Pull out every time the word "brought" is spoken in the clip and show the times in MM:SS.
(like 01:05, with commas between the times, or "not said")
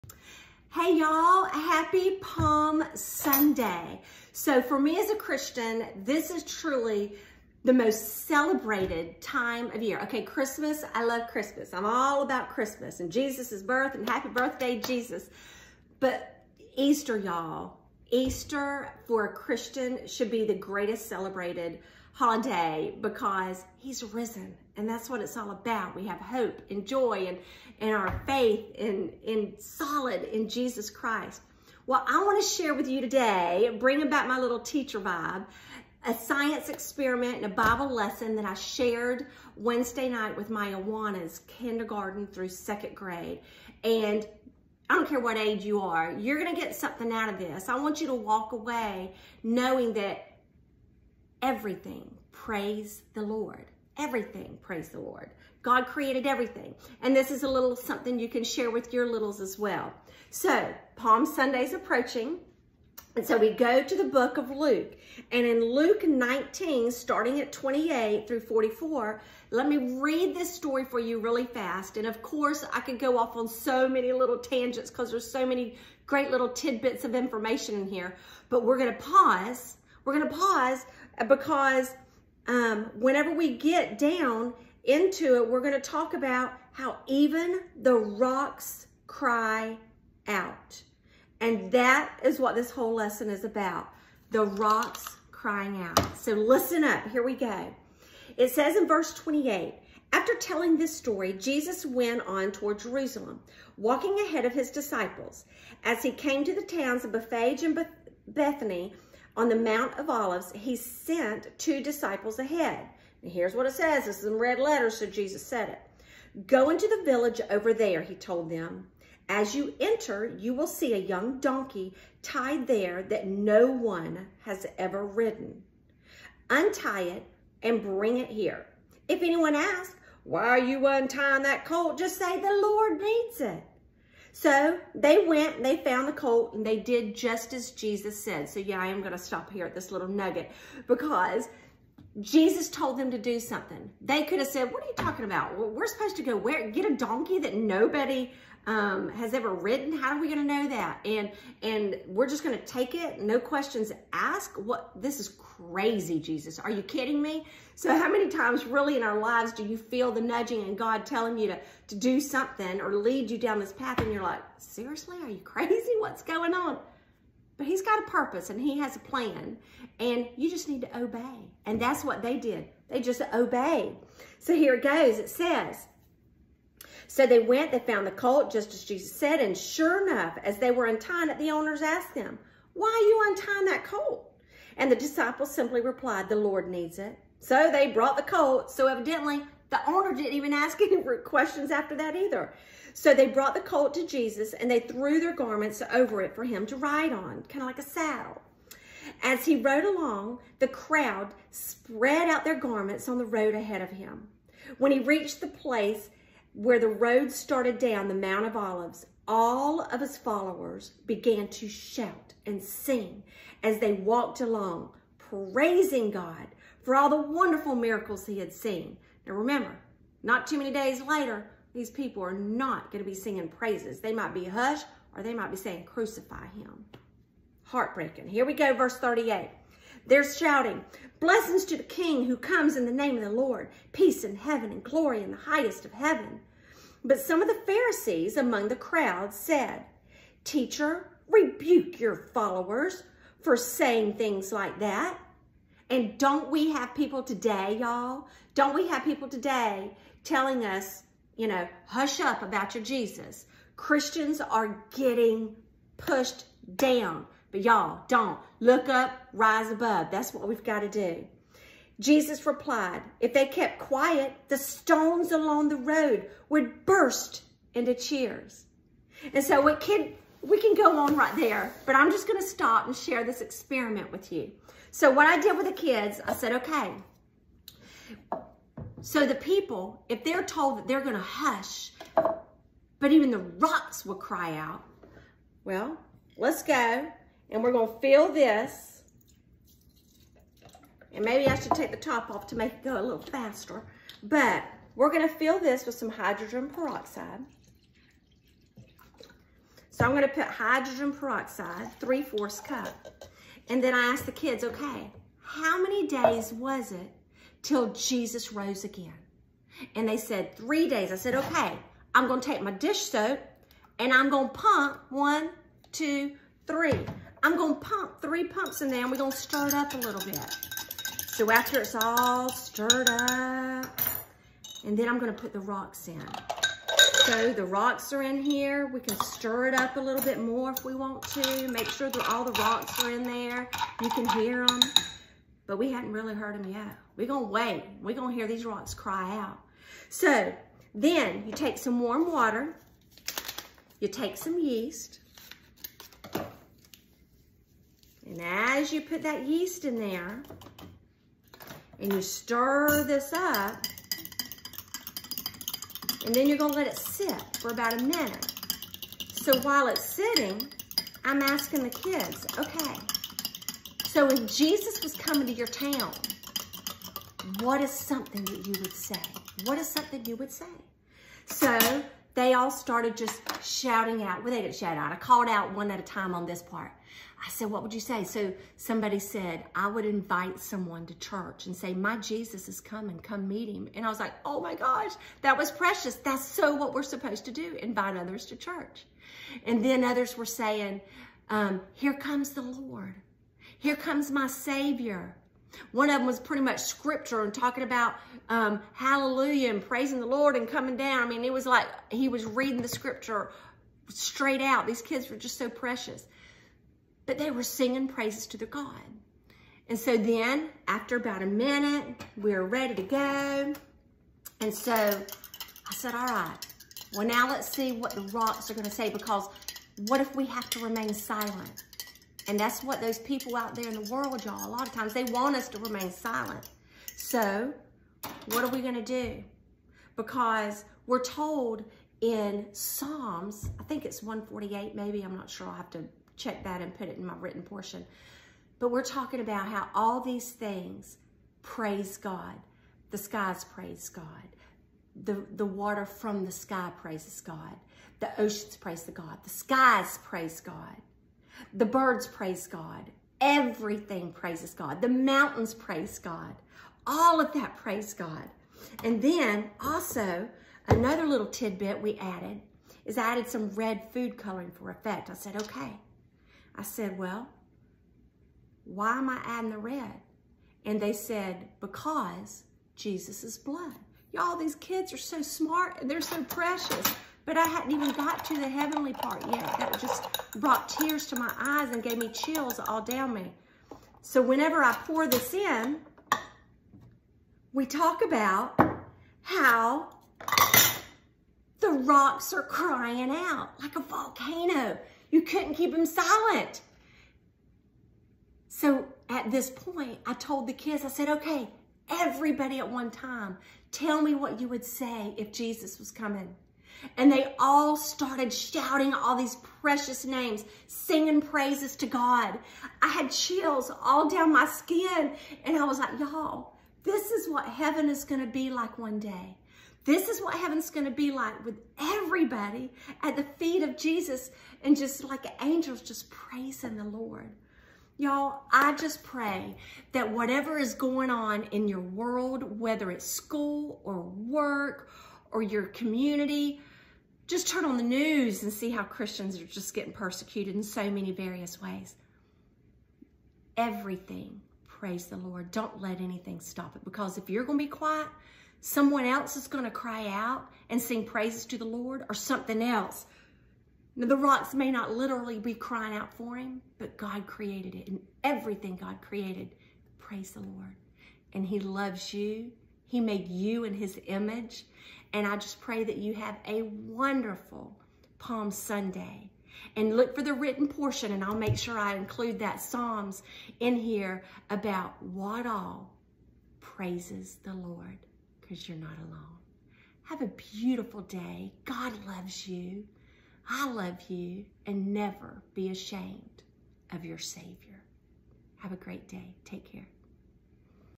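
03:07, 03:13, 08:00.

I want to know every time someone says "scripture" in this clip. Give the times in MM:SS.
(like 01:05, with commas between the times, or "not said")
06:36, 06:42.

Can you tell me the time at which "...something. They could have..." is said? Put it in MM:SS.
02:23.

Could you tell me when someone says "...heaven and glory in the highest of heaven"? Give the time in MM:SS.
03:54.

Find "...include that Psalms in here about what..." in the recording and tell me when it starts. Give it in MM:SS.
09:32.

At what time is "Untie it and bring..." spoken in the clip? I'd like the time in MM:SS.
02:06.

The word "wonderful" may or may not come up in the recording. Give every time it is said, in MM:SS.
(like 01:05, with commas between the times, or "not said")
03:37, 09:26.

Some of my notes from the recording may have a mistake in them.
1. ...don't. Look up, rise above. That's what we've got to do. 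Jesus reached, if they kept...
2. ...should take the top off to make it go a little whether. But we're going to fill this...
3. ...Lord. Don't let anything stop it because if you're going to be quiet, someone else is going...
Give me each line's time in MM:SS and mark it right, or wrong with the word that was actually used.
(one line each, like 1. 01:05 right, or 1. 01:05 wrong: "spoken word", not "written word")
1. 04:18 wrong: "replied", not "reached"
2. 04:51 wrong: "faster", not "whether"
3. 09:05 right.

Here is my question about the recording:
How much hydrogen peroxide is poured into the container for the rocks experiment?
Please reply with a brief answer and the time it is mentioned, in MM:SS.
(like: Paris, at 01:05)
3/4 cup, at 05:01.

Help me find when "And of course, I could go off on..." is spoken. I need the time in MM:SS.
01:11.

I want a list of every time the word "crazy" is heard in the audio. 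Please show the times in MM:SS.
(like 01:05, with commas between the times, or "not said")
02:35, 02:45.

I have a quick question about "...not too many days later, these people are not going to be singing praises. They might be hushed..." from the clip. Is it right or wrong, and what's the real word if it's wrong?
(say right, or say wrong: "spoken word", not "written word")
right.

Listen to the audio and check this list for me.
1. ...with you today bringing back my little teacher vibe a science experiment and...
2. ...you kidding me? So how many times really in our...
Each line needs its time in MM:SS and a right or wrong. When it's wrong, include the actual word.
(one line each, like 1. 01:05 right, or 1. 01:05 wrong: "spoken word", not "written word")
1. 00:32 right
2. 02:36 right.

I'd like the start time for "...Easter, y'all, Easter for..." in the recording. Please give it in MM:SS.
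00:16.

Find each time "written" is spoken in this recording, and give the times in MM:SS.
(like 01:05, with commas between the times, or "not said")
07:17, 09:30.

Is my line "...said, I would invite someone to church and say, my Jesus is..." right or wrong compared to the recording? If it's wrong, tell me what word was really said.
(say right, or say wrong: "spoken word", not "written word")
right.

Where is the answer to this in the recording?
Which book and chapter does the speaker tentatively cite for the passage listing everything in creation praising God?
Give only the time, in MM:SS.
07:12.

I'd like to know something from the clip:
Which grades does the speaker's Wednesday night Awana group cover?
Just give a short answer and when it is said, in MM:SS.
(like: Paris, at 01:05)
Kindergarten through second grade, at 00:41.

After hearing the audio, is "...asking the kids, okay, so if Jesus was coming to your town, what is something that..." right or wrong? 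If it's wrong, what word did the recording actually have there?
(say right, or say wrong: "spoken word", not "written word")
right.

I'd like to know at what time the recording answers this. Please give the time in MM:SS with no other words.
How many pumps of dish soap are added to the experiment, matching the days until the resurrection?
05:18.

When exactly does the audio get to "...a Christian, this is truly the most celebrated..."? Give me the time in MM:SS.
00:05.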